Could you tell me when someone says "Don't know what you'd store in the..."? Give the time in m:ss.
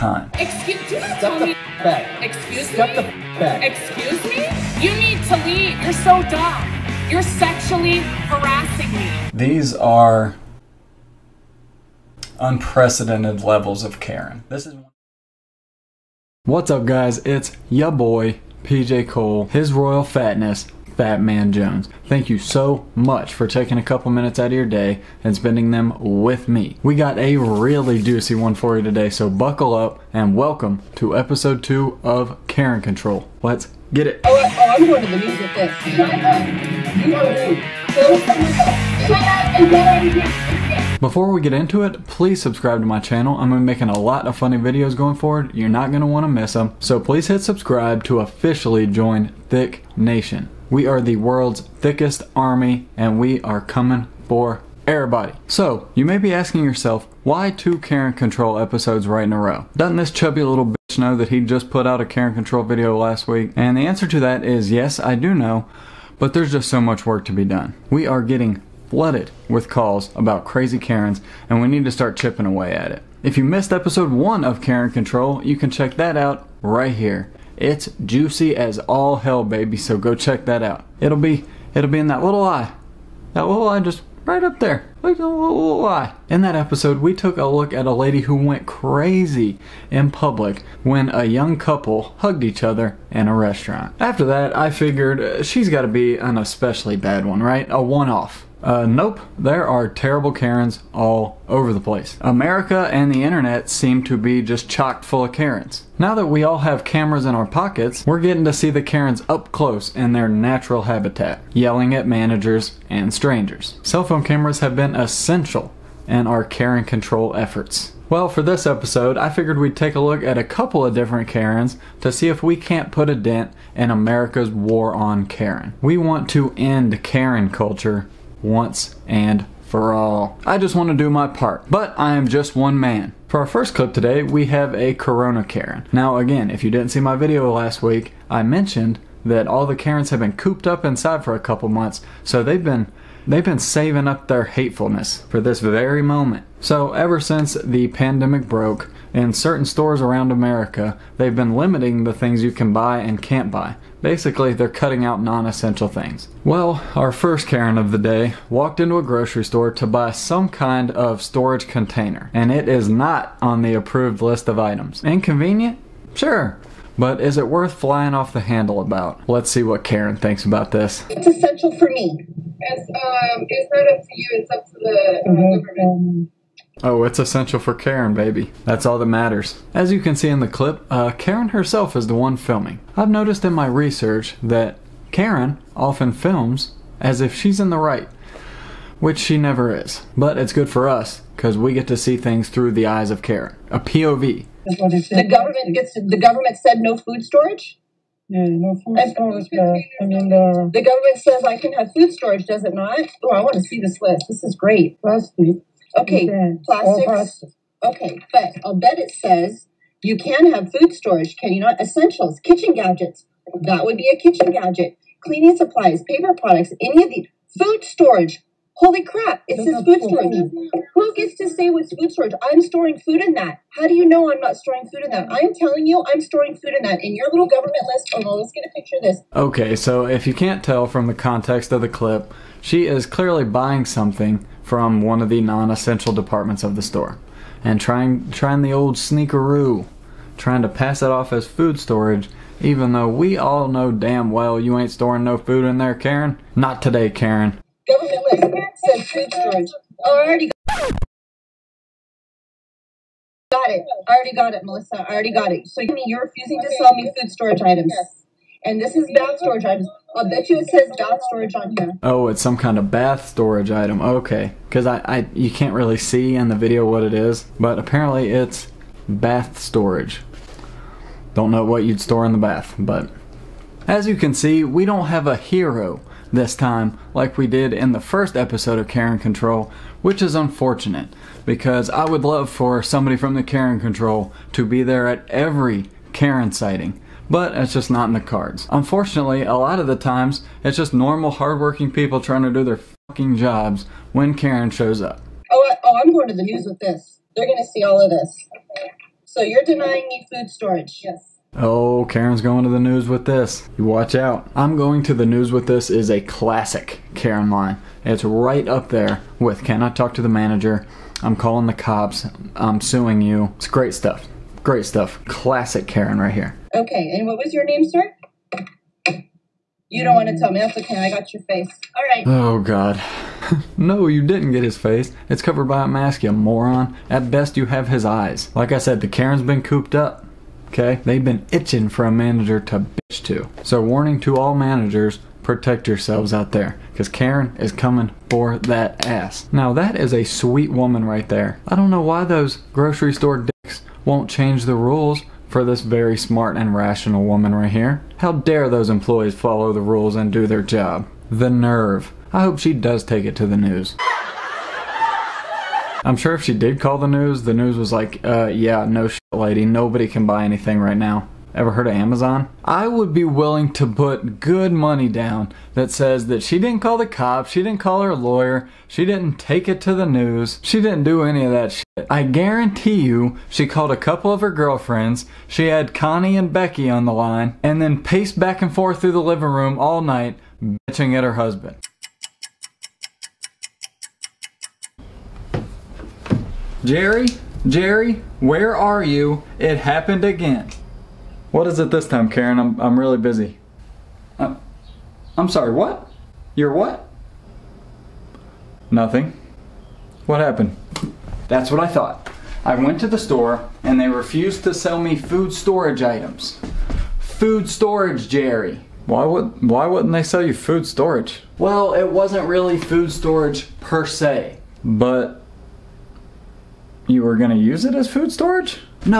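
4:31.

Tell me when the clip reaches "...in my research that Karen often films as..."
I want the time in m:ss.
3:03.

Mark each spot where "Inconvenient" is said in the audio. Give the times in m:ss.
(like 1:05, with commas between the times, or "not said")
2:45.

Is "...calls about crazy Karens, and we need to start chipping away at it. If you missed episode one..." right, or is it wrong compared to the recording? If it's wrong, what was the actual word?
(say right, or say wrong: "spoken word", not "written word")
right.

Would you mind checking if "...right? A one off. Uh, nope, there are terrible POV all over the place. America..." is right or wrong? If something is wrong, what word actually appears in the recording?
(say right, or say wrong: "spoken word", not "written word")
wrong: "Karens", not "POV".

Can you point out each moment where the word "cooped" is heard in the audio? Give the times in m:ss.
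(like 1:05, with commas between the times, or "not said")
2:20, 5:29.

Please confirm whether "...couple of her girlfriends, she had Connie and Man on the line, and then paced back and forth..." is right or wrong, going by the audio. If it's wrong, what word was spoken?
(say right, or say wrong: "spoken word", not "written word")
wrong: "Becky", not "Man".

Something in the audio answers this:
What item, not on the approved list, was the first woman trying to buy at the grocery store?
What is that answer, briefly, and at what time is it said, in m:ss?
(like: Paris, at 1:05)
storage container, at 2:41.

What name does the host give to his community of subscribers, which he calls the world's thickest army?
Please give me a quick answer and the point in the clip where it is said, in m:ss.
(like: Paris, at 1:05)
Thicc Nation, at 0:49.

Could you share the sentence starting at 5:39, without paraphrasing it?
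Now, that is a sweet woman right there.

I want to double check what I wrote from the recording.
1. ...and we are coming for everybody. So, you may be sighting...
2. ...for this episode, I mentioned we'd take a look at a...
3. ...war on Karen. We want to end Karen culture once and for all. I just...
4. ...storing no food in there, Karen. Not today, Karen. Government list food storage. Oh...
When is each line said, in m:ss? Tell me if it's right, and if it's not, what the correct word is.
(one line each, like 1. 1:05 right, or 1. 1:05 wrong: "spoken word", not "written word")
1. 0:52 wrong: "asking", not "sighting"
2. 1:58 wrong: "figured", not "mentioned"
3. 2:04 right
4. 4:04 right.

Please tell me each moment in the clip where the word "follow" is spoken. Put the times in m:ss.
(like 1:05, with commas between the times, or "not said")
5:49.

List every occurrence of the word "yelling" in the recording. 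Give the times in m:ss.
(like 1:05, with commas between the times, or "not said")
1:51.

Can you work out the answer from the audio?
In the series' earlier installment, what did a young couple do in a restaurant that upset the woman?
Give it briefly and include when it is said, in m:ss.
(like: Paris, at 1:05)
hugged each other, at 1:32.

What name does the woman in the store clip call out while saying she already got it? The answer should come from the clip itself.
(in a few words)
Melissa.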